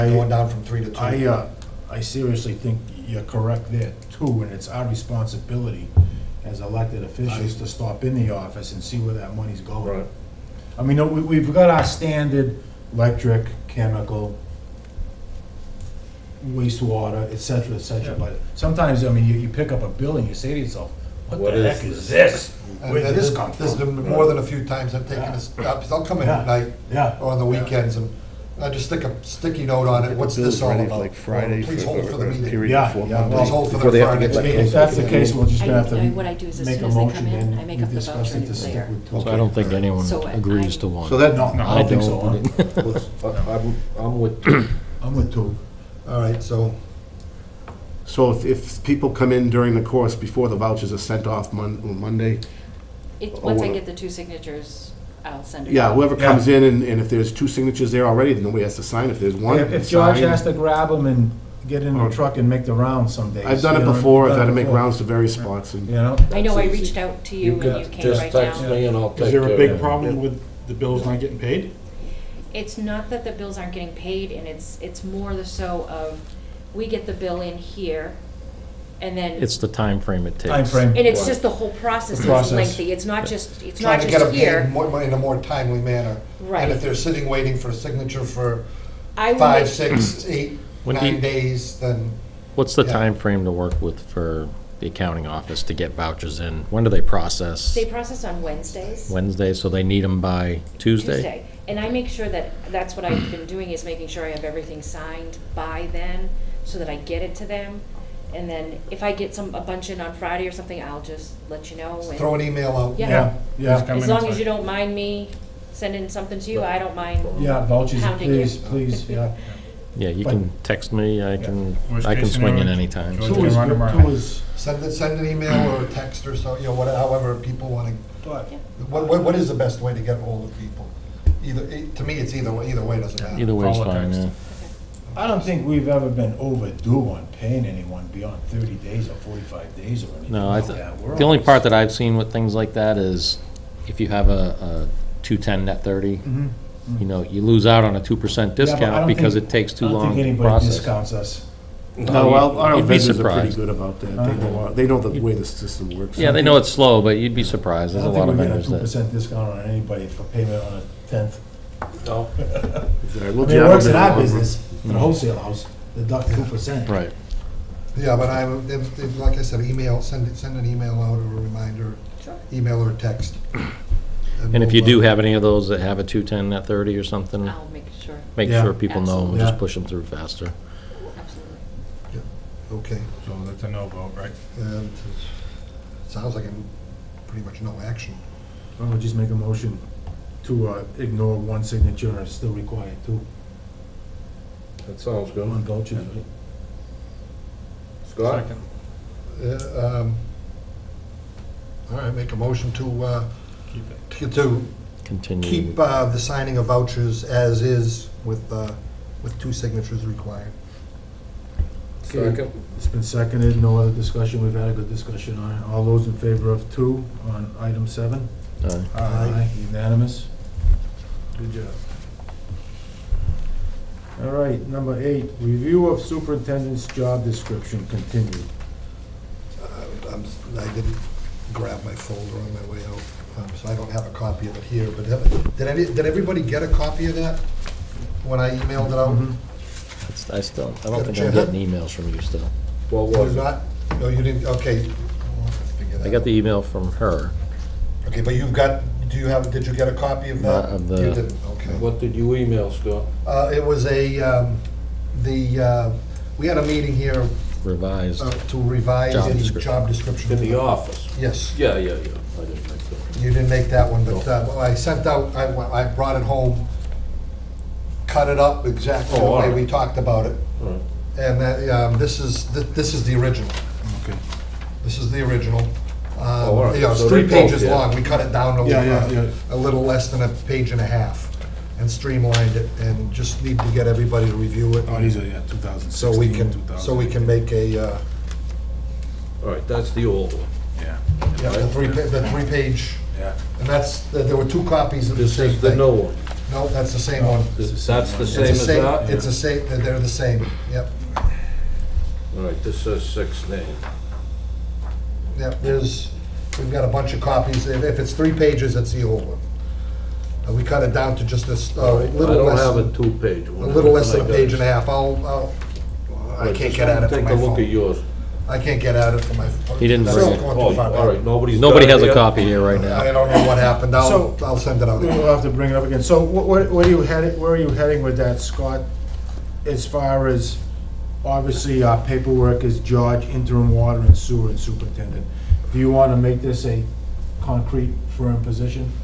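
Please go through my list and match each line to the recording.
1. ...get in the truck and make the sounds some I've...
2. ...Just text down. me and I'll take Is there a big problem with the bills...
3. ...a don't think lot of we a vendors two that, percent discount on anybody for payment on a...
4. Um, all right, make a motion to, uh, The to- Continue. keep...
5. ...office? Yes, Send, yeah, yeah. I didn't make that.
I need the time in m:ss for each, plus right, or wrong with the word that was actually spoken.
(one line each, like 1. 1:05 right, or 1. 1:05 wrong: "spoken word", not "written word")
1. 1:01 wrong: "rounds", not "sounds"
2. 1:08 right
3. 2:38 right
4. 3:19 wrong: "Keep", not "The"
5. 4:20 wrong: "Yeah", not "Send".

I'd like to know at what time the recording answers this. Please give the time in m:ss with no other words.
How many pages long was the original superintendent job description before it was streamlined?
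4:36.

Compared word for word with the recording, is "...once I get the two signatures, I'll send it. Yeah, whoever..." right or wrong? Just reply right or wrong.
right.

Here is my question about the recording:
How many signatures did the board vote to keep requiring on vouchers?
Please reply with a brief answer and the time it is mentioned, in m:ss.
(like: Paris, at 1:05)
2, at 3:29.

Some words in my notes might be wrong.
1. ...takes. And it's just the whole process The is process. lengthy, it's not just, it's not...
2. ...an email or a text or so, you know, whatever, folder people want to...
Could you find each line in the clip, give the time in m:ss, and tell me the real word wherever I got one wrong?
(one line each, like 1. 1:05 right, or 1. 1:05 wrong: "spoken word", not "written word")
1. 1:20 right
2. 2:05 wrong: "however", not "folder".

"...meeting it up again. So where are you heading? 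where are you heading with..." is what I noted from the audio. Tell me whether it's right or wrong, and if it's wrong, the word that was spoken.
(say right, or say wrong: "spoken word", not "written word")
wrong: "bring", not "meeting".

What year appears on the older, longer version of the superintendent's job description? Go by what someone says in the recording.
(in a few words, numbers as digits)
2016.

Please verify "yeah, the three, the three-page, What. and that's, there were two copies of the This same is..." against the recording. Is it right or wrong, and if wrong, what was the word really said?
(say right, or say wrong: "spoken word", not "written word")
wrong: "Yeah", not "What".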